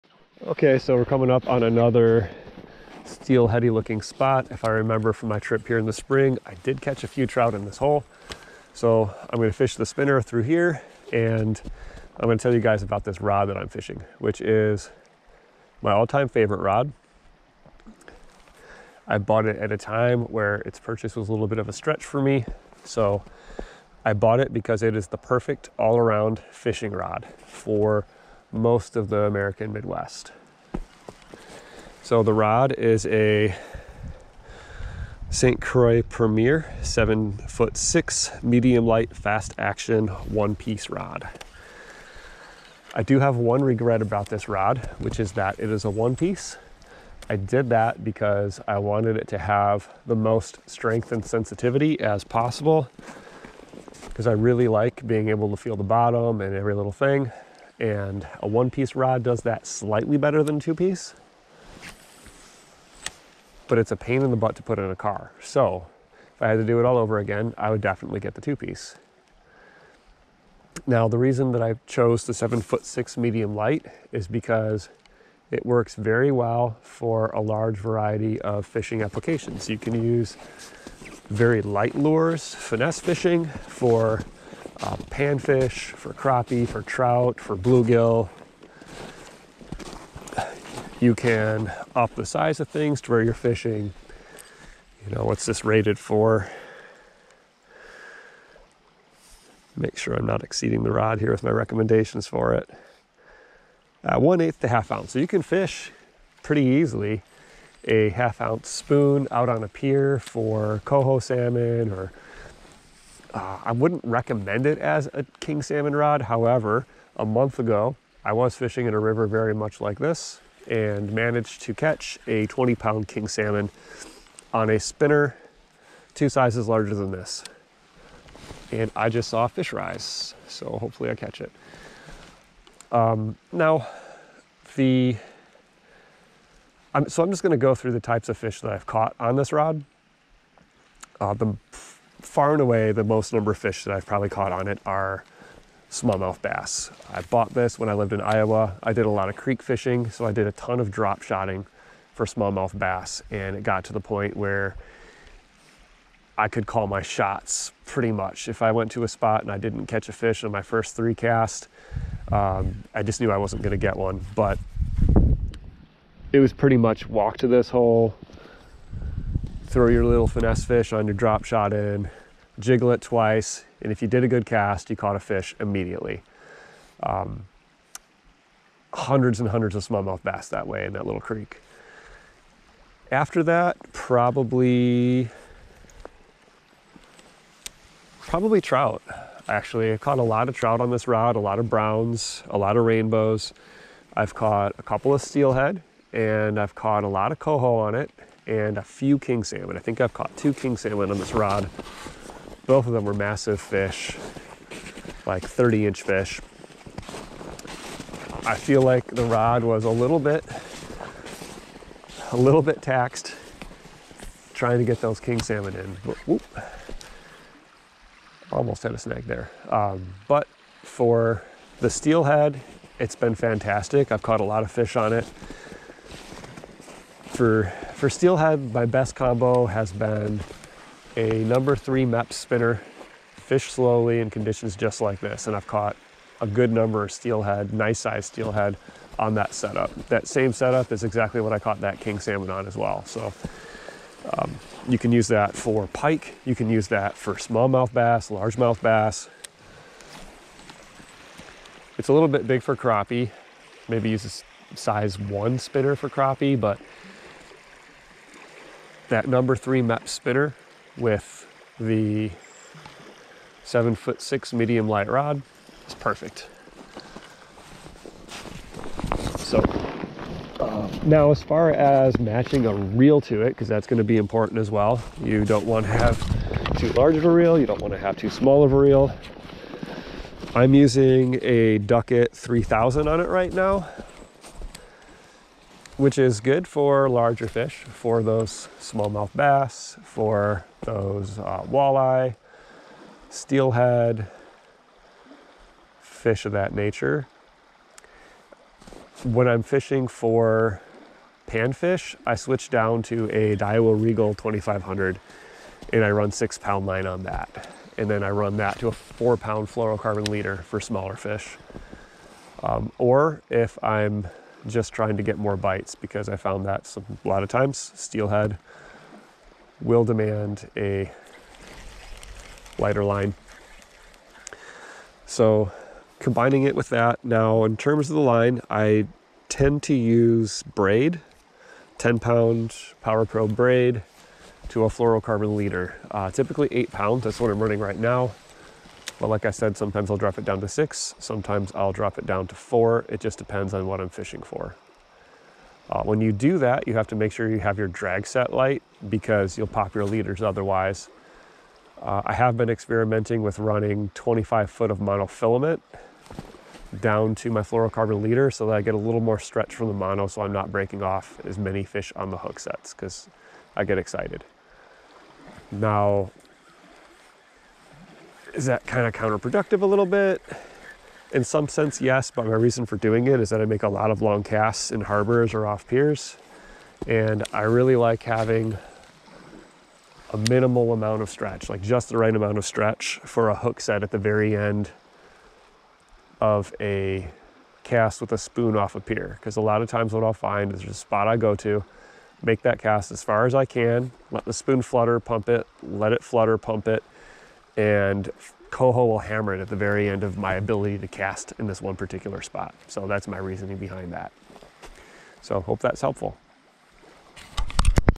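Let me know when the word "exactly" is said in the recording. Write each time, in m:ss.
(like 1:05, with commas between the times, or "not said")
4:01.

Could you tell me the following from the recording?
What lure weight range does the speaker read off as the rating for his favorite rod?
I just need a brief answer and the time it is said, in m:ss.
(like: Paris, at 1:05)
1/8 to 1/2 ounce, at 1:44.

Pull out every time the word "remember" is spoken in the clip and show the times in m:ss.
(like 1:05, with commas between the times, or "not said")
0:04.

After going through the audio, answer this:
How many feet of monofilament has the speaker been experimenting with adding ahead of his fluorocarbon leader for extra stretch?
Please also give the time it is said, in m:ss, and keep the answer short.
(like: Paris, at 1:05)
25 feet, at 5:54.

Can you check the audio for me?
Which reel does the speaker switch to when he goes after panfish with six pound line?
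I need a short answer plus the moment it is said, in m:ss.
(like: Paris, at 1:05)
Daiwa Regal 2500, at 5:03.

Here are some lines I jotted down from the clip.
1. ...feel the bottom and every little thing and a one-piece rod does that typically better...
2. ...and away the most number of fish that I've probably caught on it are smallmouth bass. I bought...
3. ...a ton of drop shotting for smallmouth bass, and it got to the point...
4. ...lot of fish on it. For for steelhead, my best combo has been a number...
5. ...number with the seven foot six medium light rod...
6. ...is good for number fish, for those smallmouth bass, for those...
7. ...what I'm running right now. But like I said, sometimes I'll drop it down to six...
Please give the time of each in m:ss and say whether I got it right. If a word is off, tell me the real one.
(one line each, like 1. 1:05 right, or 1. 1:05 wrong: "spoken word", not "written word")
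1. 0:55 wrong: "slightly", not "typically"
2. 2:22 right
3. 2:30 right
4. 3:44 right
5. 4:20 wrong: "spinner", not "number"
6. 4:46 wrong: "larger", not "number"
7. 5:37 right.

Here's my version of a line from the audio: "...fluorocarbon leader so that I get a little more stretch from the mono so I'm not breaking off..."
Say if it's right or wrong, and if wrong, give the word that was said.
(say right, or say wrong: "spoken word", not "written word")
right.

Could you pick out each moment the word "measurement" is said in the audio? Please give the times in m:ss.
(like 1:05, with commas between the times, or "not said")
not said.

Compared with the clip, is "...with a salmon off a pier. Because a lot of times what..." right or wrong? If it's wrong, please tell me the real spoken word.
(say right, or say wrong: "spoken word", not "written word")
wrong: "spoon", not "salmon".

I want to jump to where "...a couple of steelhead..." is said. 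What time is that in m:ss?
3:14.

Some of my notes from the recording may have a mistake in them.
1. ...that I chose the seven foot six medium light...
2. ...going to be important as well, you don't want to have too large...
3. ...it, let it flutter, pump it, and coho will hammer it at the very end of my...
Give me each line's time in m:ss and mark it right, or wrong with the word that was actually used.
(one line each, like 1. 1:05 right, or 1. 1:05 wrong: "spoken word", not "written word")
1. 1:11 right
2. 4:33 right
3. 6:35 right.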